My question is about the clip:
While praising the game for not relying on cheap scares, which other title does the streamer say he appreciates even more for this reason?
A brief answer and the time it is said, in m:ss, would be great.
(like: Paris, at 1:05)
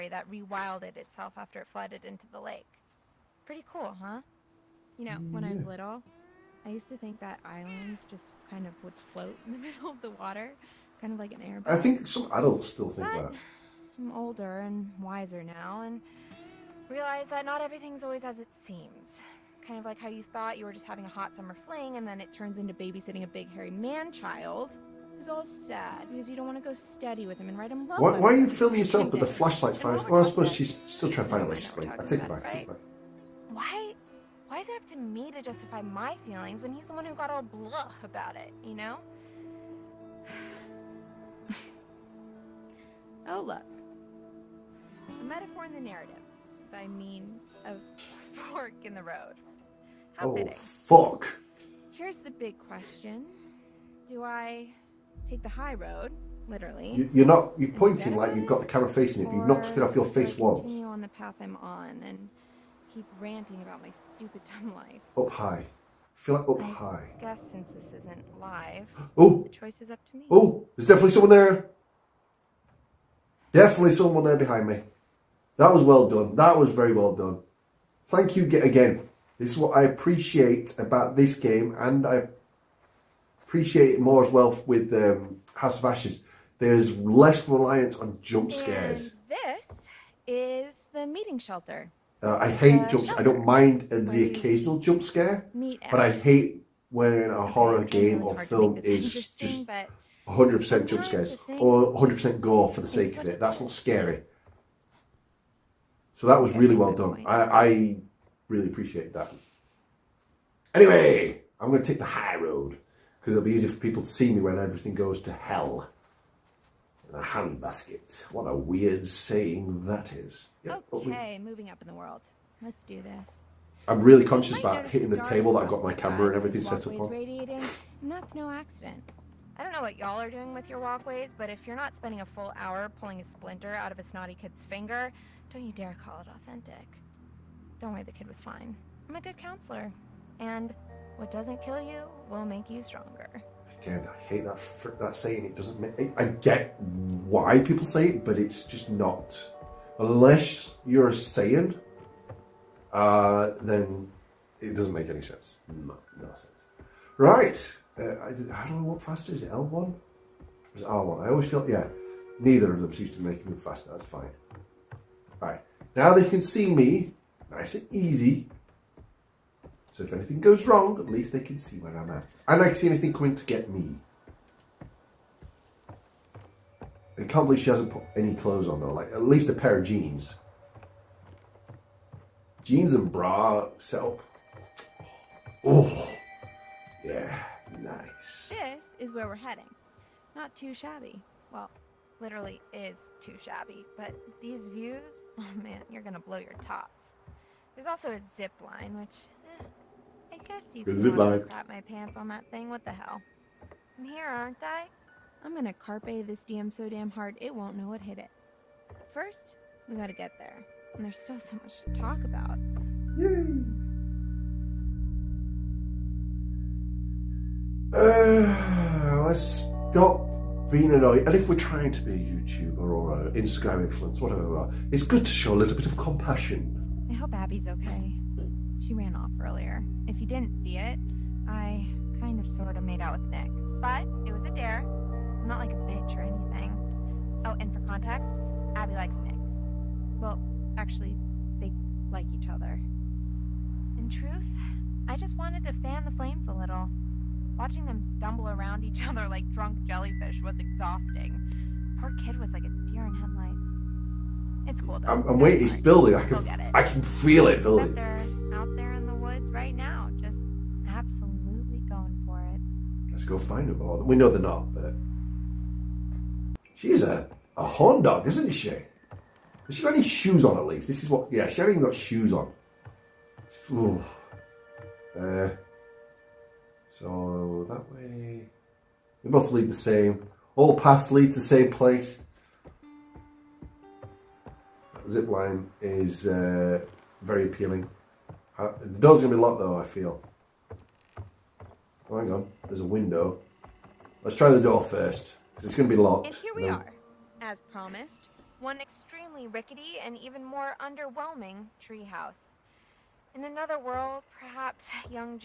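House of Ashes, at 1:25.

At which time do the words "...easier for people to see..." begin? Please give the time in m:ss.
1:53.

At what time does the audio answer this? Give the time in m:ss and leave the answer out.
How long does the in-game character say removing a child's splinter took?
2:12.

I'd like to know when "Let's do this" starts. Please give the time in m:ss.
2:02.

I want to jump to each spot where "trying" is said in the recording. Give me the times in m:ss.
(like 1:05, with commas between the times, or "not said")
0:31, 3:41.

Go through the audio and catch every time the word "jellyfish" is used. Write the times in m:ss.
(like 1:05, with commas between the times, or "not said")
4:09.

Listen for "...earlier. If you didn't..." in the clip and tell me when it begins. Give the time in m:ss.
3:49.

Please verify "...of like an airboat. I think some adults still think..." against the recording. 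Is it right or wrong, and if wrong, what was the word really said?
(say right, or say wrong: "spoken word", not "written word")
right.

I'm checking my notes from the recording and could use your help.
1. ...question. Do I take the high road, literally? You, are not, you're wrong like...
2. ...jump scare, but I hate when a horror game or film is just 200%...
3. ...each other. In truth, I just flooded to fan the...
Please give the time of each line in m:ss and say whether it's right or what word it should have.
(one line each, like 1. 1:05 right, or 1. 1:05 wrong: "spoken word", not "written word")
1. 0:52 wrong: "pointing", not "wrong"
2. 1:34 wrong: "100", not "200"
3. 4:02 wrong: "wanted", not "flooded".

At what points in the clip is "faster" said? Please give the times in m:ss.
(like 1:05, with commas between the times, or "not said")
2:39, 2:43.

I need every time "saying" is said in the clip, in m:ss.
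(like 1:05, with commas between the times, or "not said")
1:59, 2:25, 2:31.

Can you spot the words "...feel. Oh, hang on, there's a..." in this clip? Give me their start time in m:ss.
4:49.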